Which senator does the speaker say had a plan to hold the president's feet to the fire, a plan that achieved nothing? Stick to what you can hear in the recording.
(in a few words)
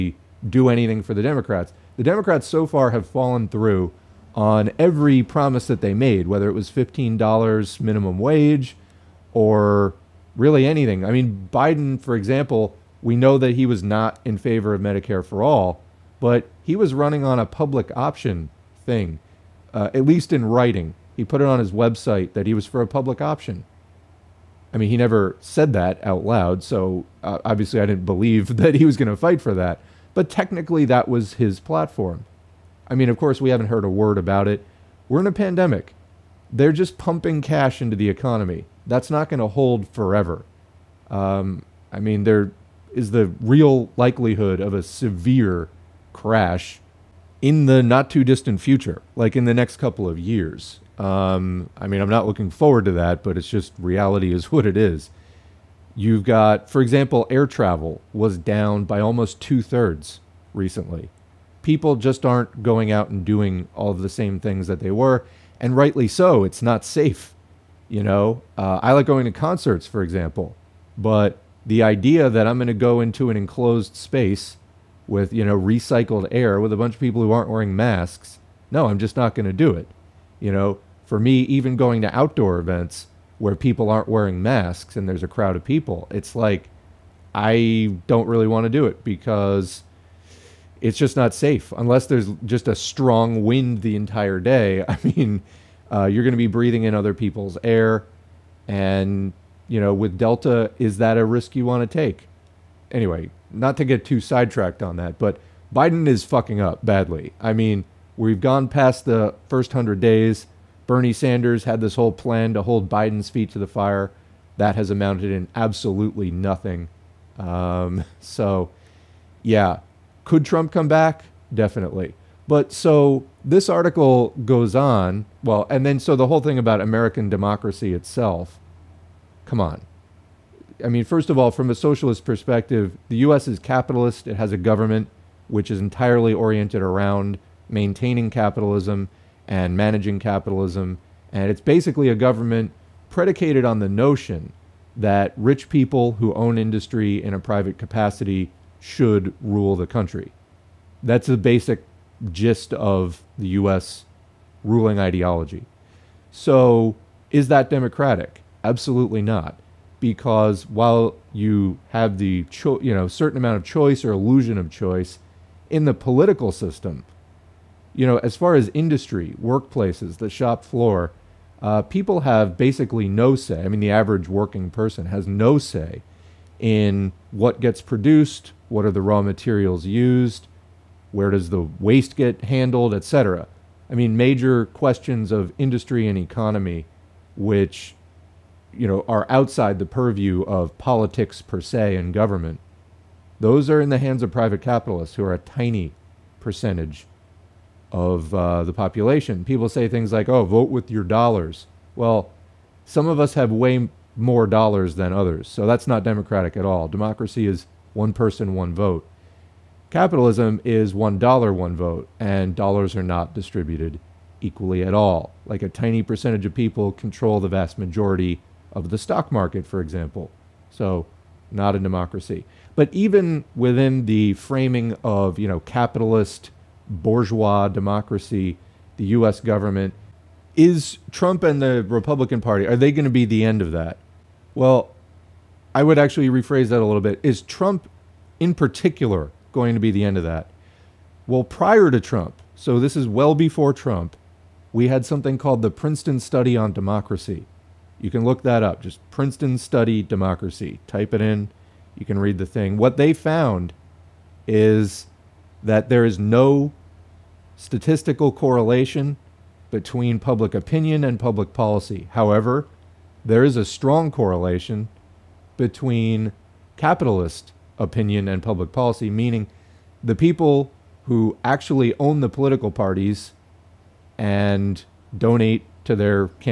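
Bernie Sanders.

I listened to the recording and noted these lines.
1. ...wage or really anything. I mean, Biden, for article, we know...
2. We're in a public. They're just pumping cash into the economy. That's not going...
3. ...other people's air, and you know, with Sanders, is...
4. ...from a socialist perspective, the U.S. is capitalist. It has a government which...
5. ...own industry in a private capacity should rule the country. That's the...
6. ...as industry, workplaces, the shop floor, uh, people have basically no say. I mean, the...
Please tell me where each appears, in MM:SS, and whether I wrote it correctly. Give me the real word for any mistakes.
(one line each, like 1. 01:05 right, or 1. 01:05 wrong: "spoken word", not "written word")
1. 00:08 wrong: "example", not "article"
2. 00:35 wrong: "pandemic", not "public"
3. 01:36 wrong: "Delta", not "Sanders"
4. 02:11 right
5. 02:26 right
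6. 02:48 right.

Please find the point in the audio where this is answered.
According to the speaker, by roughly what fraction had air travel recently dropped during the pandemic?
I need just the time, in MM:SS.
00:59.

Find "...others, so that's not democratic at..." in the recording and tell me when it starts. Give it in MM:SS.
03:25.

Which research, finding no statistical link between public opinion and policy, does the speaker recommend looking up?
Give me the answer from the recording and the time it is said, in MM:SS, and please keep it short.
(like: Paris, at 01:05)
Princeton Study on Democracy, at 04:05.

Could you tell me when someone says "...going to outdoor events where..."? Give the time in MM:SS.
01:21.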